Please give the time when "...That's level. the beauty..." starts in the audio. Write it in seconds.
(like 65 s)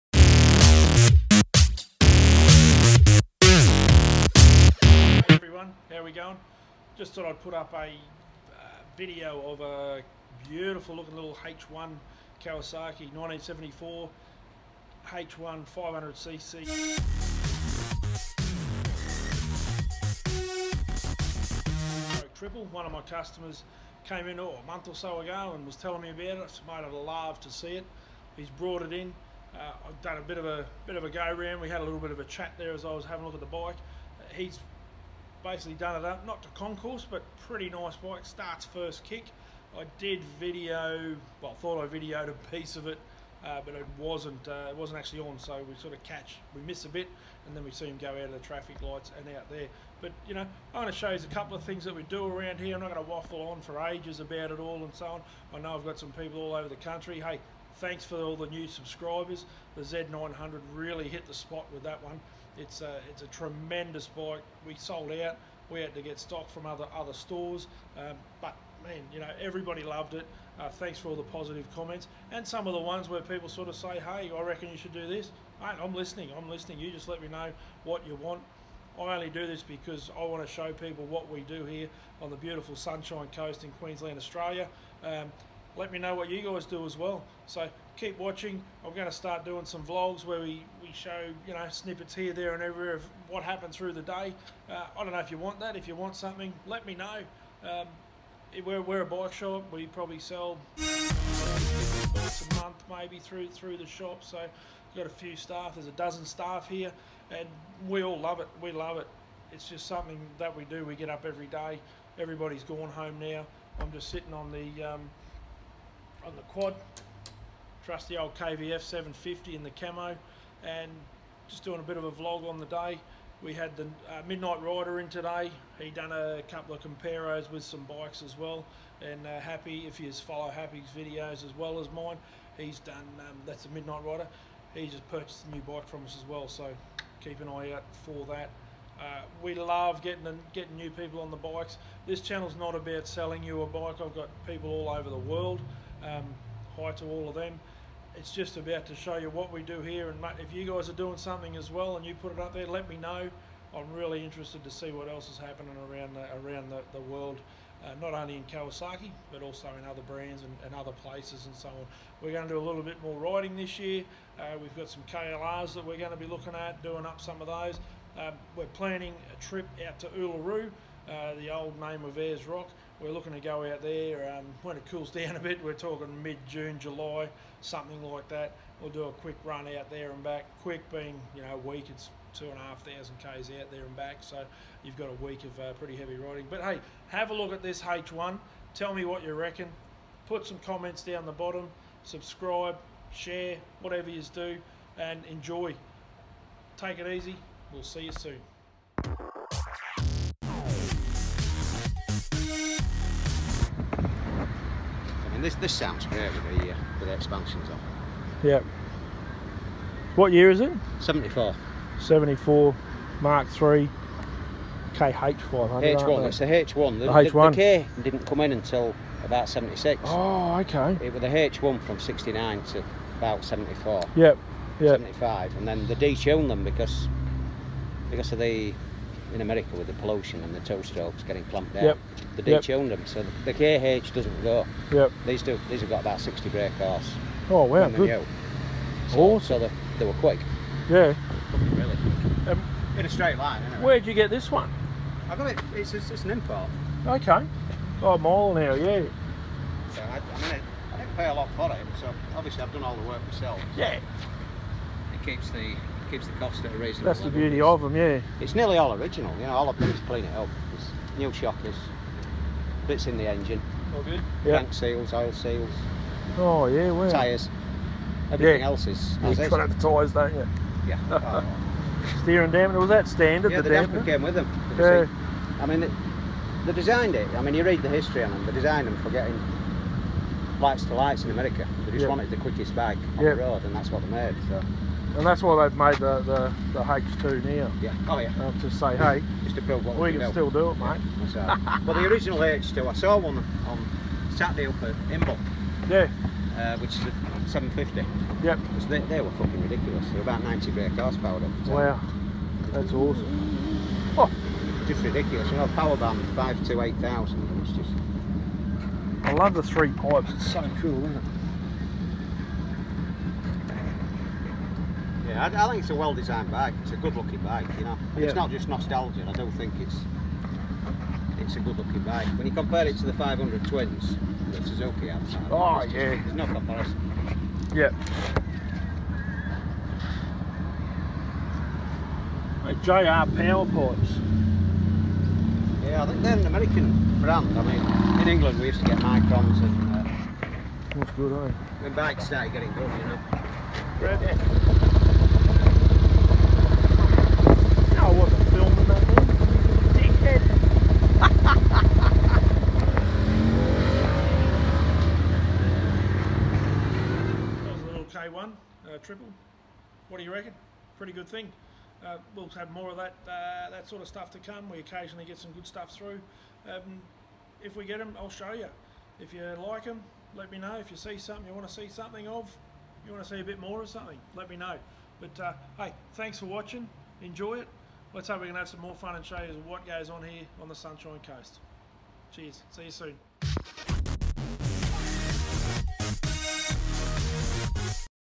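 257 s.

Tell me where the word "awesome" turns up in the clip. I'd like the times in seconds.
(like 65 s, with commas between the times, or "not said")
239 s, 302 s.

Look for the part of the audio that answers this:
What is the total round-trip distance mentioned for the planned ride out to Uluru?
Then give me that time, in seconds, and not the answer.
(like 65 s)
182 s.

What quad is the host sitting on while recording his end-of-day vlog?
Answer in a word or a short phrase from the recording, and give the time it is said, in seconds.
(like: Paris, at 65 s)
KVF 750, at 118 s.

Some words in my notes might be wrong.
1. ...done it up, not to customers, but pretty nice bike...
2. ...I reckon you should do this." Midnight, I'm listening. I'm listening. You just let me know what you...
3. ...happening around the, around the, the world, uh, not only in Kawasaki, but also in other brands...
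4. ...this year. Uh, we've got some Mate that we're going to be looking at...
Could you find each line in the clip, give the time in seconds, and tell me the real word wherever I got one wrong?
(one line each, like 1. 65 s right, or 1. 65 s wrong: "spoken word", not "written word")
1. 35 s wrong: "concours", not "customers"
2. 74 s wrong: "Mate", not "Midnight"
3. 155 s right
4. 163 s wrong: "KLRs", not "Mate".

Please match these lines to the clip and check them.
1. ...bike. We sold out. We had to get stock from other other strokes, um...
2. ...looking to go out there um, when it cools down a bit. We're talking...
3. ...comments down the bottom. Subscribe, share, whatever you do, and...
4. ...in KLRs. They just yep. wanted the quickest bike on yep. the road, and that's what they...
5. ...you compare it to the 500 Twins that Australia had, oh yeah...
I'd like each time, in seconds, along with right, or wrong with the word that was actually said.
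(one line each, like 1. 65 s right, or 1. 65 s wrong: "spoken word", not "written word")
1. 64 s wrong: "stores", not "strokes"
2. 173 s right
3. 190 s right
4. 281 s wrong: "America", not "KLRs"
5. 322 s wrong: "Suzuki", not "Australia".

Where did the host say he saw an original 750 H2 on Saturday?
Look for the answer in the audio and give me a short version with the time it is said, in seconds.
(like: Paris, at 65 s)
Imbil, at 294 s.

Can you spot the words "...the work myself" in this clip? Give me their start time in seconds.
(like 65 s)
252 s.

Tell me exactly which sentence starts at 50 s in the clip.
But, you know, I want to show you a couple of things that we do around here.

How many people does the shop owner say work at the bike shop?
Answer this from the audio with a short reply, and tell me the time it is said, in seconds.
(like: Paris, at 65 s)
a dozen, at 105 s.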